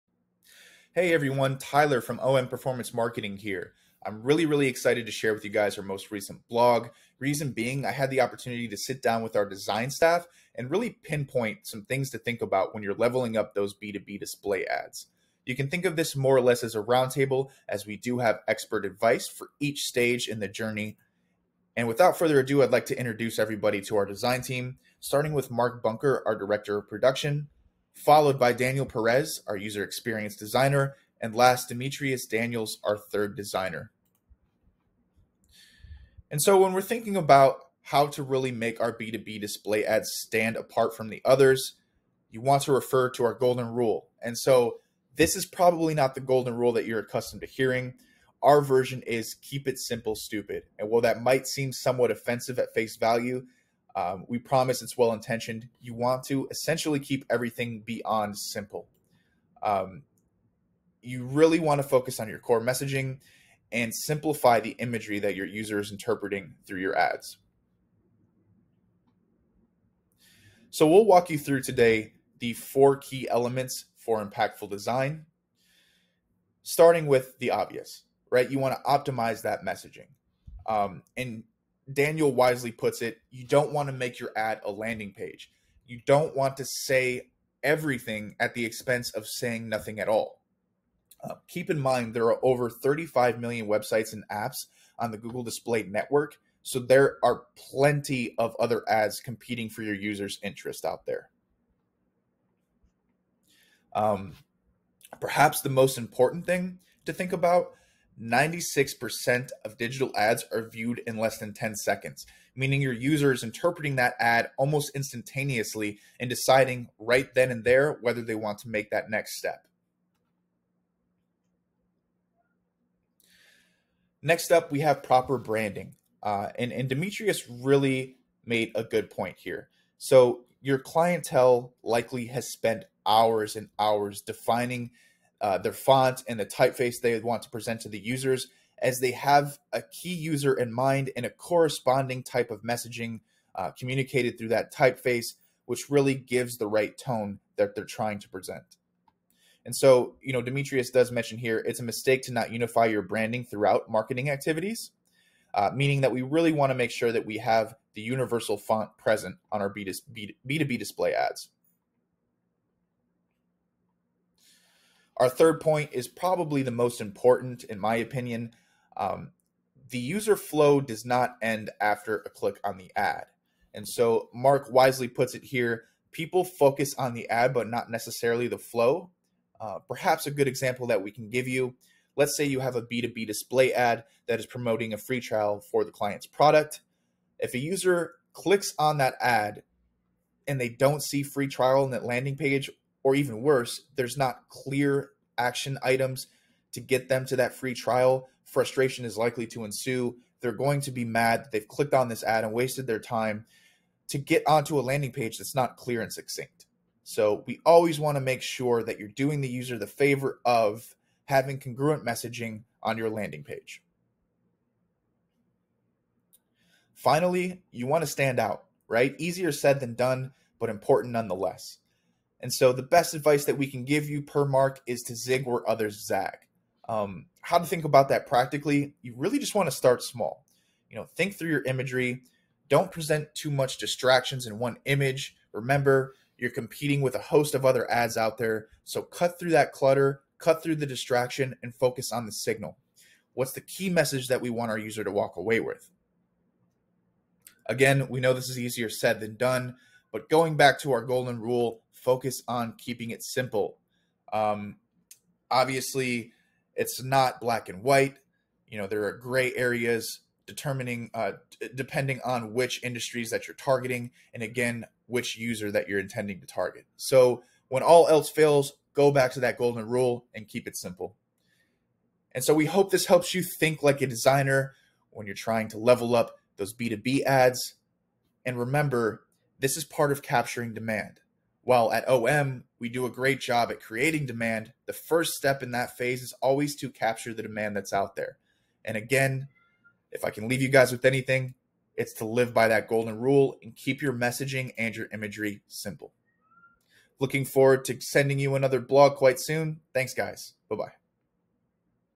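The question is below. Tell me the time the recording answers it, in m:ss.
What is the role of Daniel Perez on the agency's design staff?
0:29.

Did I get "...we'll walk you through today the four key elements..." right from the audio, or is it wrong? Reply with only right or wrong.
right.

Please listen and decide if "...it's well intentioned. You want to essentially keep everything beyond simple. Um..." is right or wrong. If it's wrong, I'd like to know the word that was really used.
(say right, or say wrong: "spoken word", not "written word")
right.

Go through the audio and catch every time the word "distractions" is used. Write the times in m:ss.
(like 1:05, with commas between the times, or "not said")
3:53, 4:00.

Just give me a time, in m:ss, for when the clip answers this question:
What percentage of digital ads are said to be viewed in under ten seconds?
1:48.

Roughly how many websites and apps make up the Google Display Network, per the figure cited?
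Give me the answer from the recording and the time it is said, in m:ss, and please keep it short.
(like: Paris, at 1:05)
35 million, at 1:32.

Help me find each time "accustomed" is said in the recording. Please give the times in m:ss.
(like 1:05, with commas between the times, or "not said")
0:46.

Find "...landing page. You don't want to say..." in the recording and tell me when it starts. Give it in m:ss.
1:24.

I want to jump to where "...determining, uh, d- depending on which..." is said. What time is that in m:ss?
4:20.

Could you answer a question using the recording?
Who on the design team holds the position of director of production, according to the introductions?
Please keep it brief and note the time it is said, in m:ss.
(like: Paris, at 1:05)
Mark Bunker, at 0:25.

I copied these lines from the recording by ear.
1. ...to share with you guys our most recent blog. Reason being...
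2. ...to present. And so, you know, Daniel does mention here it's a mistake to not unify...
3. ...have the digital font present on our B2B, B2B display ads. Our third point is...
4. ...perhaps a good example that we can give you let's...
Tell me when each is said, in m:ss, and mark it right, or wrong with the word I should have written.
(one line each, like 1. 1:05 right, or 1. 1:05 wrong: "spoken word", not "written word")
1. 0:05 right
2. 2:28 wrong: "Demetrius", not "Daniel"
3. 2:37 wrong: "universal", not "digital"
4. 2:59 right.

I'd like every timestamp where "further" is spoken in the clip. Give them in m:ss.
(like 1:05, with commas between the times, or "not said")
0:22.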